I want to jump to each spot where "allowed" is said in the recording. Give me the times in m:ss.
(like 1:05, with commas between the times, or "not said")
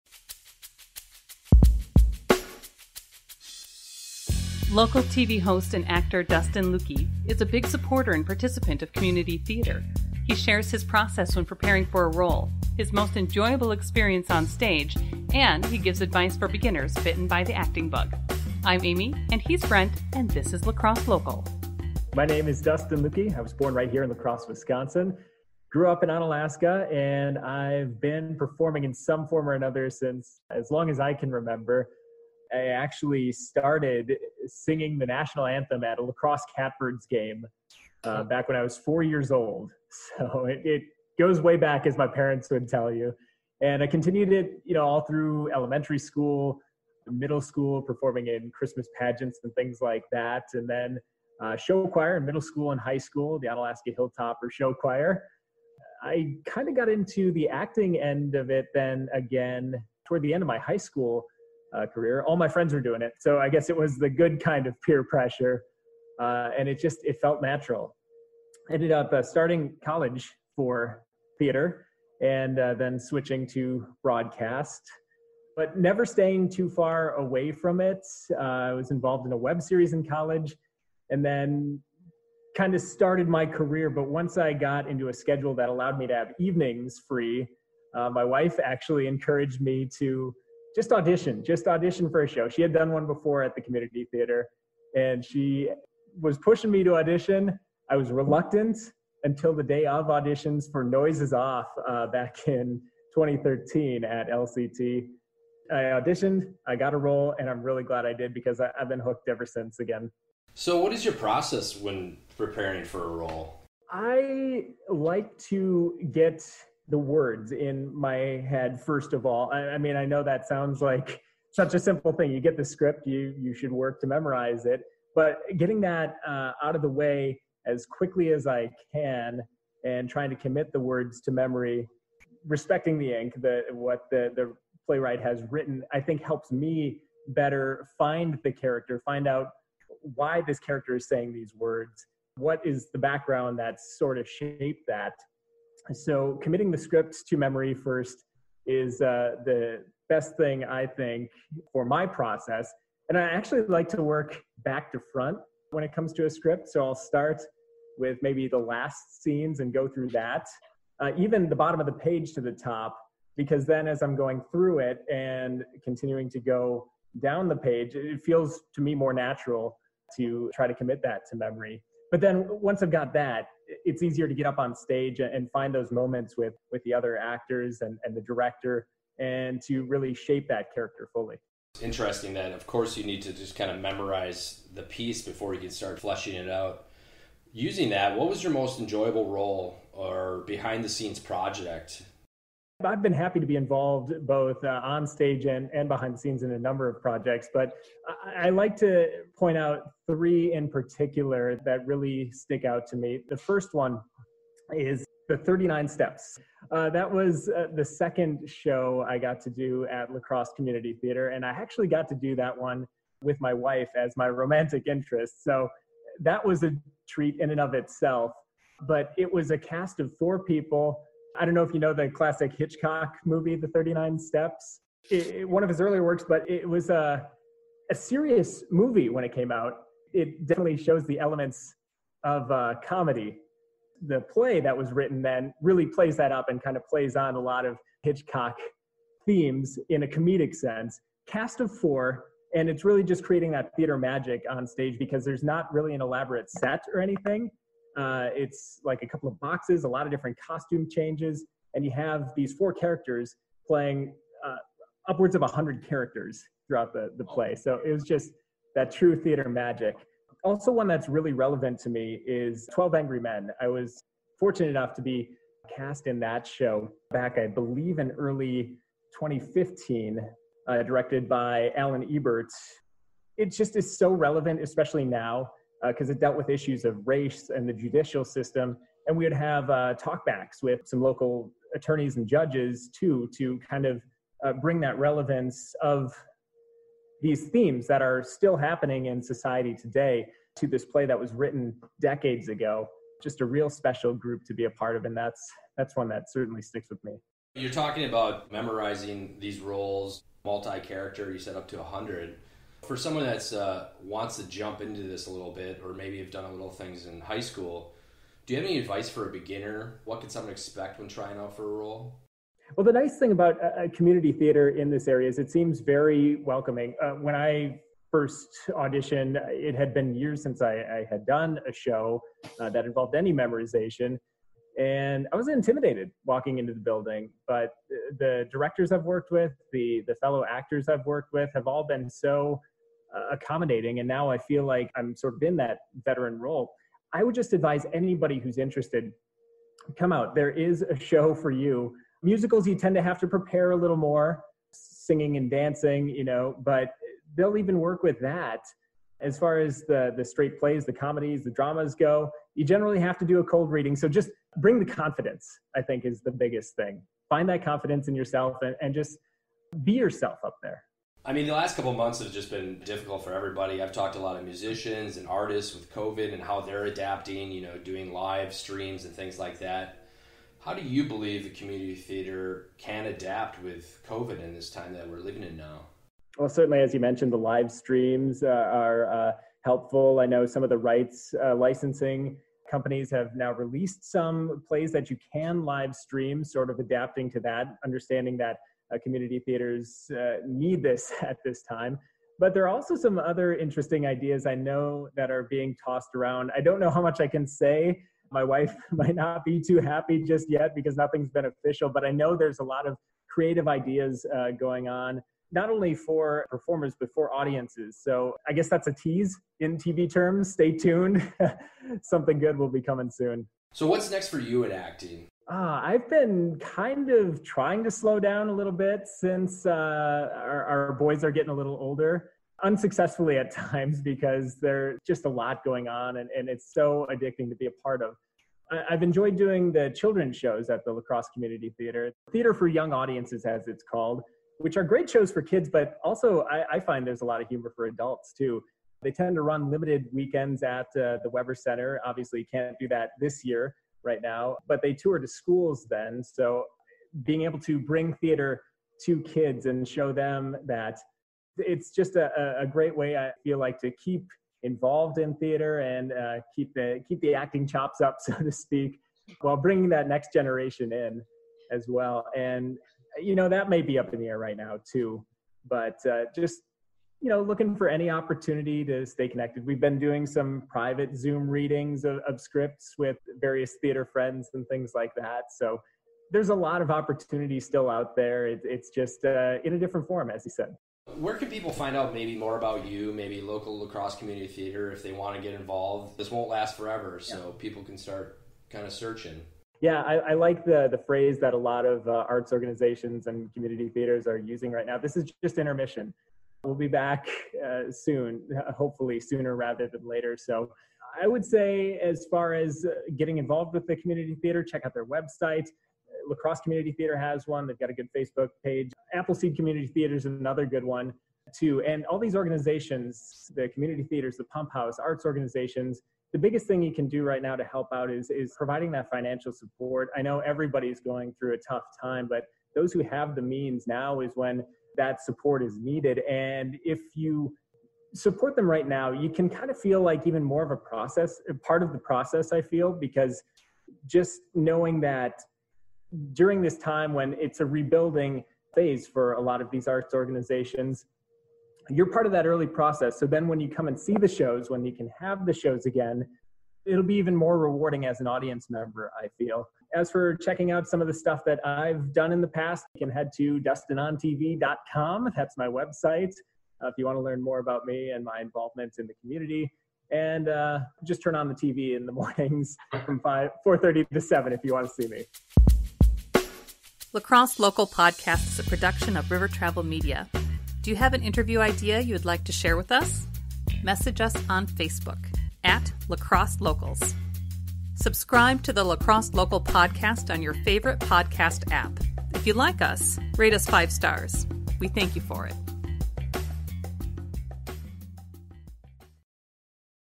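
1:25.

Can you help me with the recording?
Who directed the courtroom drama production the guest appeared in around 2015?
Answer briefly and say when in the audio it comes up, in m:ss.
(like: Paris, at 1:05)
Alan Ebert, at 4:31.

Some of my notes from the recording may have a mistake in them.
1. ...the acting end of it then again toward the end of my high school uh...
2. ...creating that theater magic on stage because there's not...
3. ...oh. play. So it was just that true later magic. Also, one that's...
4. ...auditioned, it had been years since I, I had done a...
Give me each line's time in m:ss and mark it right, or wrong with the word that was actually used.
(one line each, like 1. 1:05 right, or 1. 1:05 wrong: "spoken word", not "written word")
1. 0:57 right
2. 4:03 right
3. 4:17 wrong: "theater", not "later"
4. 5:18 right.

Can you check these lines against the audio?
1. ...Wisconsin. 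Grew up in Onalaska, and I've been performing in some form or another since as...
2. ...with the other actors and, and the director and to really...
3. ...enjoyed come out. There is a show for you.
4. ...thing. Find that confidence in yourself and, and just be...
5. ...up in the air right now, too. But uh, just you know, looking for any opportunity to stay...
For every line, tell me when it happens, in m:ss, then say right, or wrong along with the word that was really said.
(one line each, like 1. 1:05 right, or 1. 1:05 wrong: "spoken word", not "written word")
1. 0:24 right
2. 2:56 right
3. 5:38 wrong: "interested", not "enjoyed"
4. 5:56 right
5. 7:43 right.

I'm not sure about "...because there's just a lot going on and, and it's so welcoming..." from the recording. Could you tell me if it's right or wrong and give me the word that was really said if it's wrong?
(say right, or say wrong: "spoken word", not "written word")
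wrong: "addicting", not "welcoming".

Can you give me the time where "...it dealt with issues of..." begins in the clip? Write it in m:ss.
4:36.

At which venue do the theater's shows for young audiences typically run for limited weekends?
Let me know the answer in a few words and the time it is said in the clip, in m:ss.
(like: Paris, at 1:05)
Weber Center, at 7:21.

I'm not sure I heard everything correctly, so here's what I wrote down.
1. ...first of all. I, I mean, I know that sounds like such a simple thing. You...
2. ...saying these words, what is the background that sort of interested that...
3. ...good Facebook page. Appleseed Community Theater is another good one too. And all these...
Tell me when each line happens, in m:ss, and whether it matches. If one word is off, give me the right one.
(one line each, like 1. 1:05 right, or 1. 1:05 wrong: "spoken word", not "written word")
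1. 1:58 right
2. 2:21 wrong: "shaped", not "interested"
3. 8:27 right.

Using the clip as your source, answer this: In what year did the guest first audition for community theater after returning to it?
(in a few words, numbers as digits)
2013.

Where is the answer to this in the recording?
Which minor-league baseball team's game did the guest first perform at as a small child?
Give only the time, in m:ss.
0:36.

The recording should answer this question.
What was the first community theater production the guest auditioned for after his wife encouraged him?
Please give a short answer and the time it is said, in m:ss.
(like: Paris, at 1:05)
Noises Off, at 1:40.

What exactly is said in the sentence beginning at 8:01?
Where can people find out maybe more about you, maybe local La Crosse community theater if they want to get involved?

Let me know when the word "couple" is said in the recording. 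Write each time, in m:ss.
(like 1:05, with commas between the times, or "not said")
4:09, 6:01.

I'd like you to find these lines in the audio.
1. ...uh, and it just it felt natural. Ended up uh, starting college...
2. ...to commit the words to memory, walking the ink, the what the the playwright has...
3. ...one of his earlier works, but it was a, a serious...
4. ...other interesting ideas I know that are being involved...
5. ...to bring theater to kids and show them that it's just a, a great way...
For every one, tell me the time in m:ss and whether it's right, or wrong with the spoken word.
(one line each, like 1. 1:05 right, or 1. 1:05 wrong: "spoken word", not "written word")
1. 1:06 right
2. 2:10 wrong: "respecting", not "walking"
3. 3:45 right
4. 6:33 wrong: "tossed", not "involved"
5. 7:27 right.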